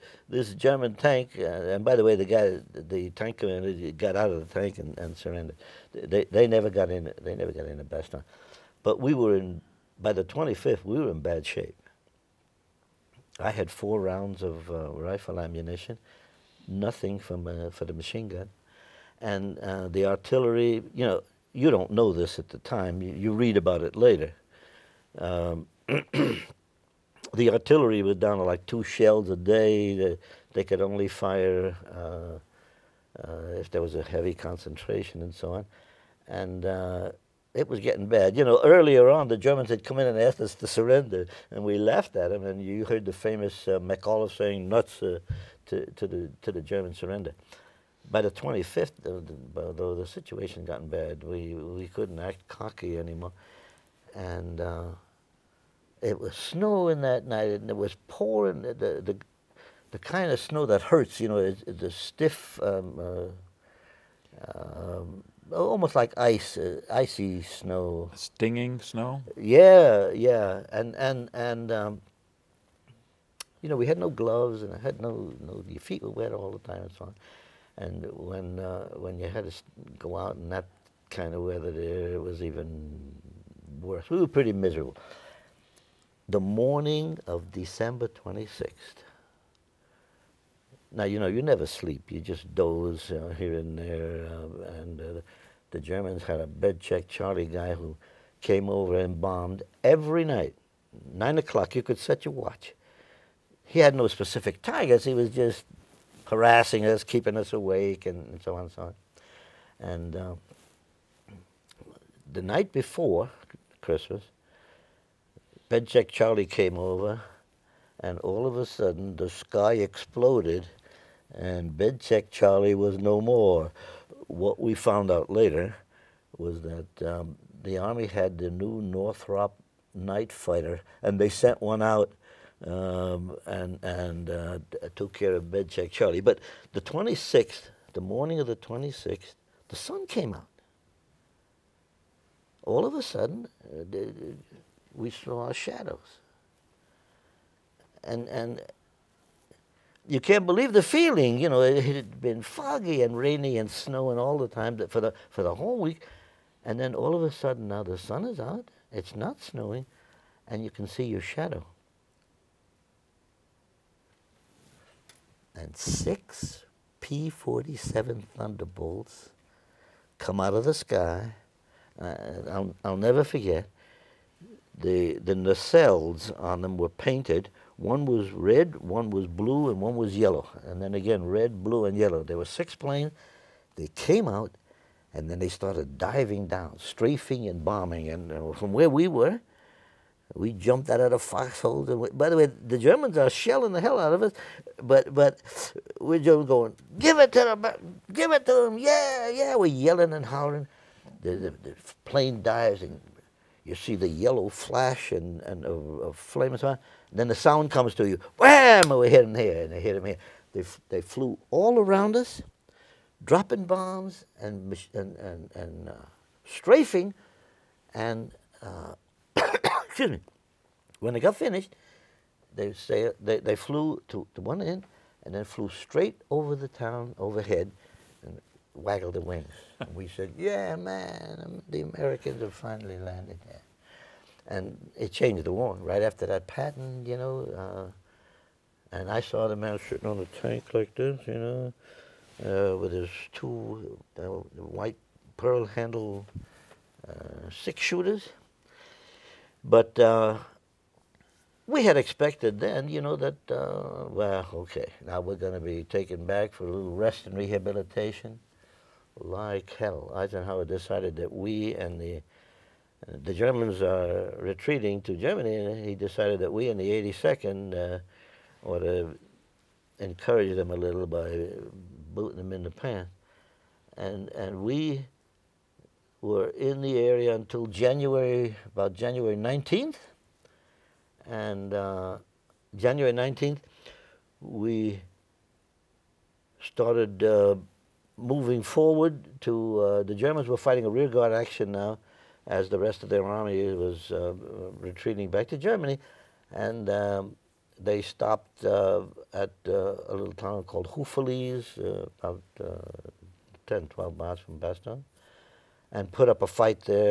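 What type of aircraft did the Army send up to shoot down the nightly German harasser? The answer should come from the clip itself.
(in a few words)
Northrop night fighter.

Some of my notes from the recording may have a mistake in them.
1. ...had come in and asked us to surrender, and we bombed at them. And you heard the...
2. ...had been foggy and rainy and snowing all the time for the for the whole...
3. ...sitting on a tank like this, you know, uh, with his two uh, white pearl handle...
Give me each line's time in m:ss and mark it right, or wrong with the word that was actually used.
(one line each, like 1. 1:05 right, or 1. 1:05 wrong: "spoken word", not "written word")
1. 0:39 wrong: "laughed", not "bombed"
2. 2:31 right
3. 3:59 right.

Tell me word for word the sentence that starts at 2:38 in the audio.
It's not snowing, and you can see your shadow.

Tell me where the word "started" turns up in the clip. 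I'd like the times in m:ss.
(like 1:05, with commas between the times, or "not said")
3:05, 4:46.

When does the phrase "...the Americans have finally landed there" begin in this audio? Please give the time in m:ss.
3:51.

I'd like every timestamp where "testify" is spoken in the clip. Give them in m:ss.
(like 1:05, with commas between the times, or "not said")
not said.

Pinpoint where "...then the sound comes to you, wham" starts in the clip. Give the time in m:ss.
3:27.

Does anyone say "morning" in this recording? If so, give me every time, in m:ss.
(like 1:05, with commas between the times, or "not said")
1:26, 2:18.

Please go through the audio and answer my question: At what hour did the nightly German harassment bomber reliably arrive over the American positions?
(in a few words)
9 o'clock.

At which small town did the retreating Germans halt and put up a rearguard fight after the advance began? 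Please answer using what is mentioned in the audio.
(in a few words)
Houffalize.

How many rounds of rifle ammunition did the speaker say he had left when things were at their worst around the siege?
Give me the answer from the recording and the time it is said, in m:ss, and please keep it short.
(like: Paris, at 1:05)
4, at 0:13.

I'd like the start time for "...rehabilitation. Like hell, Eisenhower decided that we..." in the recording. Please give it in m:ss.
4:17.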